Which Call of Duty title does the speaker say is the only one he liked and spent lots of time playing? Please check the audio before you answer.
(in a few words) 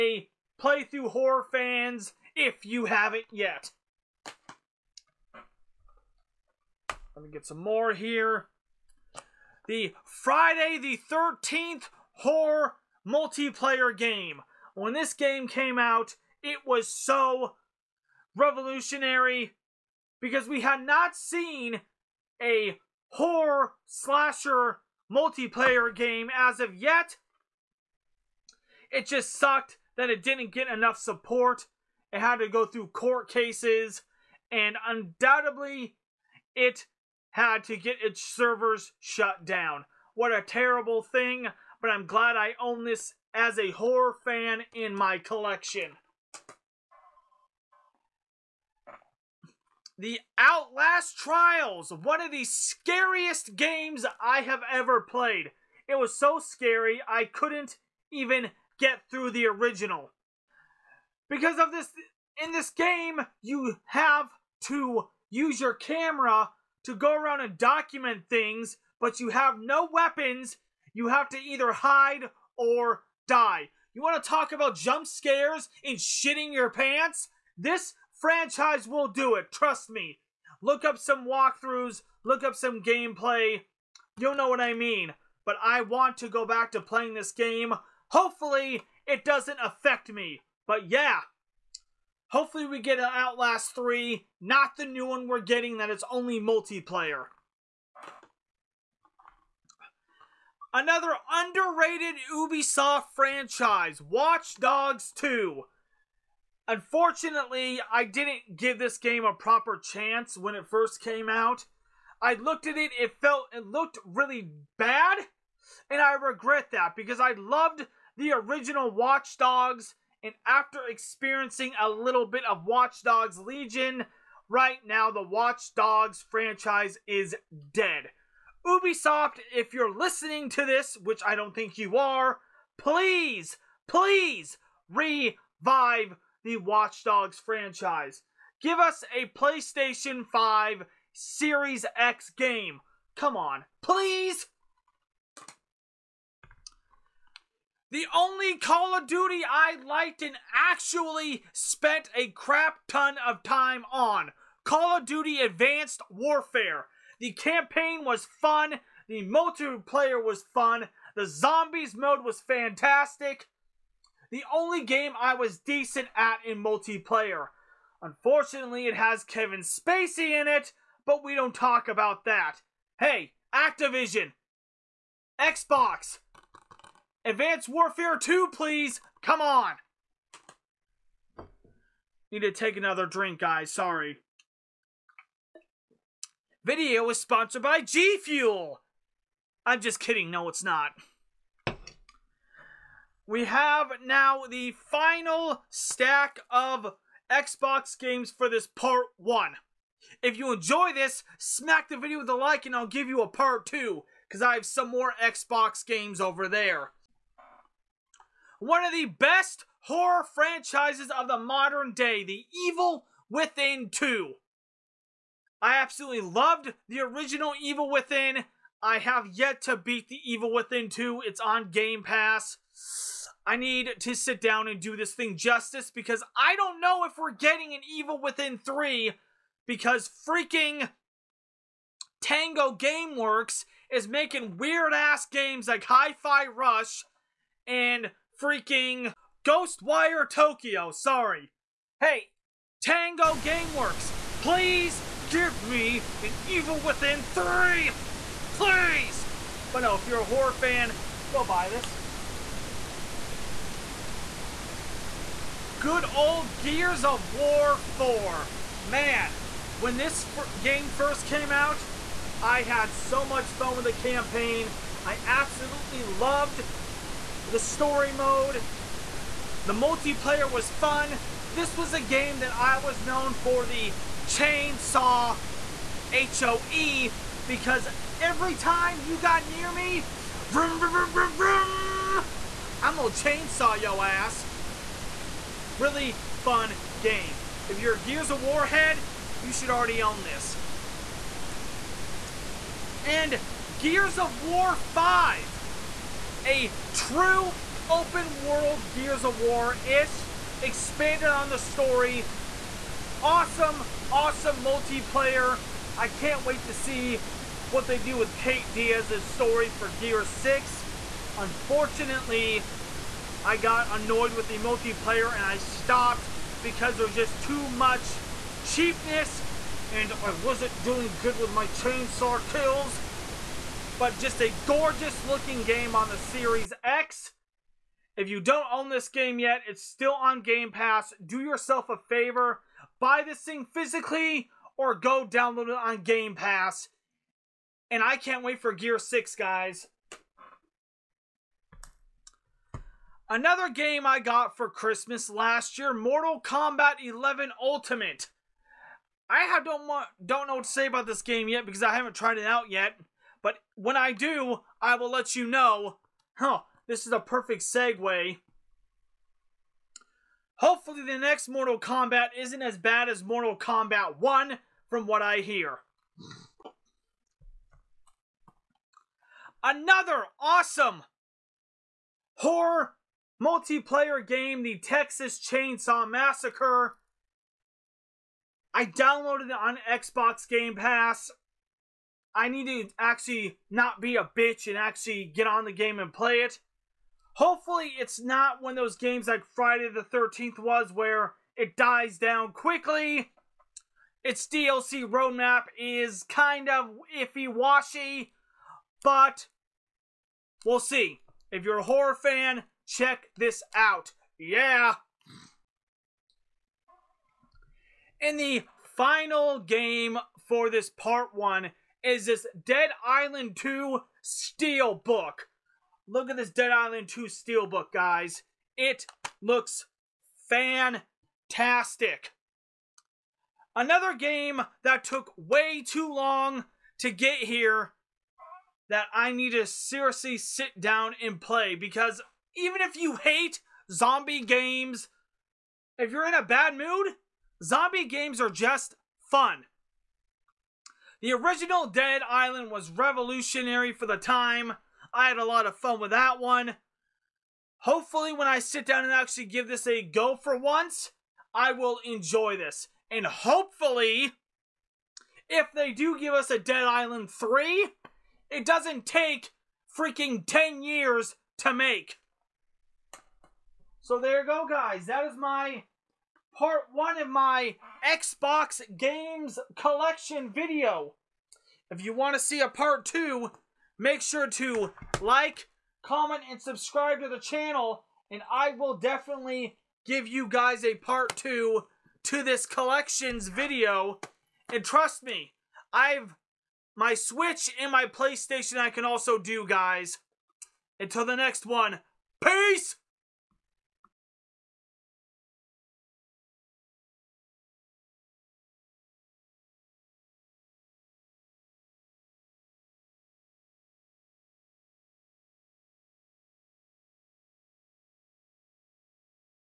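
Call of Duty Advanced Warfare.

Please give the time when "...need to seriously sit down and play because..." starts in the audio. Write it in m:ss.
7:09.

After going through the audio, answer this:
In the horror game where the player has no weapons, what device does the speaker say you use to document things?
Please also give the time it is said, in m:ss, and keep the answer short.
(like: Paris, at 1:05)
Camera, at 1:05.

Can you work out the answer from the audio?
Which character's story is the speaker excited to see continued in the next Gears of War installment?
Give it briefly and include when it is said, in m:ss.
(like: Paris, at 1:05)
Kate Diaz, at 5:08.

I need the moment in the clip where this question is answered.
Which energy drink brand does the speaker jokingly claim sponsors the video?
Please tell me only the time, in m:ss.
3:07.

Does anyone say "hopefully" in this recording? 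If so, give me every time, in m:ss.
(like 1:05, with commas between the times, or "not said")
1:28, 1:32, 6:00, 6:27, 7:27, 7:33.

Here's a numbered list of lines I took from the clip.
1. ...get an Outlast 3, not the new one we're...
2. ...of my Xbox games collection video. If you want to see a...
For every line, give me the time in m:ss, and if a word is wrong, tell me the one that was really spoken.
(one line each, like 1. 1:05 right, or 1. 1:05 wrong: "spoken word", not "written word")
1. 1:32 right
2. 7:47 right.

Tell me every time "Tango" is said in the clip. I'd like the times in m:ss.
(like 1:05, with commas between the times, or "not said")
3:52, 4:02.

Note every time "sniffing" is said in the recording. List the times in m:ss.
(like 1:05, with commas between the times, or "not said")
not said.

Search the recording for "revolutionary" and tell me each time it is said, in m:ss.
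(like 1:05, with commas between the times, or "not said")
0:18, 7:22.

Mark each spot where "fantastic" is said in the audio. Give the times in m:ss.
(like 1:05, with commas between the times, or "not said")
2:42, 7:00.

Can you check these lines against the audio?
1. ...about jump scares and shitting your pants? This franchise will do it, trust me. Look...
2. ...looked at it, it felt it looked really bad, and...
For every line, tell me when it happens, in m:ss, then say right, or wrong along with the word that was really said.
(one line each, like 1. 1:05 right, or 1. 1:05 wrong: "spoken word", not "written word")
1. 1:14 right
2. 1:52 right.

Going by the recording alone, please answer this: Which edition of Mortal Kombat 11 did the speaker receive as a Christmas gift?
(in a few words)
Ultimate.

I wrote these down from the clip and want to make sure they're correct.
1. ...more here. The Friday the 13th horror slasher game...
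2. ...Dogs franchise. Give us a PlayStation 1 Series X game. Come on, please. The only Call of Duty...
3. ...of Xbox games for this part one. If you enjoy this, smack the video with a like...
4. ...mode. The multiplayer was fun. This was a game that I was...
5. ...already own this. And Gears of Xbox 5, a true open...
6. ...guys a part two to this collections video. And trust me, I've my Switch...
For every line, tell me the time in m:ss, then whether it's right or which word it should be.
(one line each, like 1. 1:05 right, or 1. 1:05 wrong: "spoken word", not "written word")
1. 0:07 wrong: "multiplayer", not "slasher"
2. 2:17 wrong: "5", not "1"
3. 3:16 right
4. 4:28 right
5. 4:49 wrong: "War", not "Xbox"
6. 8:00 right.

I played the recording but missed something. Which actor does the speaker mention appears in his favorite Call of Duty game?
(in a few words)
Kevin Spacey.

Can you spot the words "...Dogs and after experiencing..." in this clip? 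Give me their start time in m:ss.
1:59.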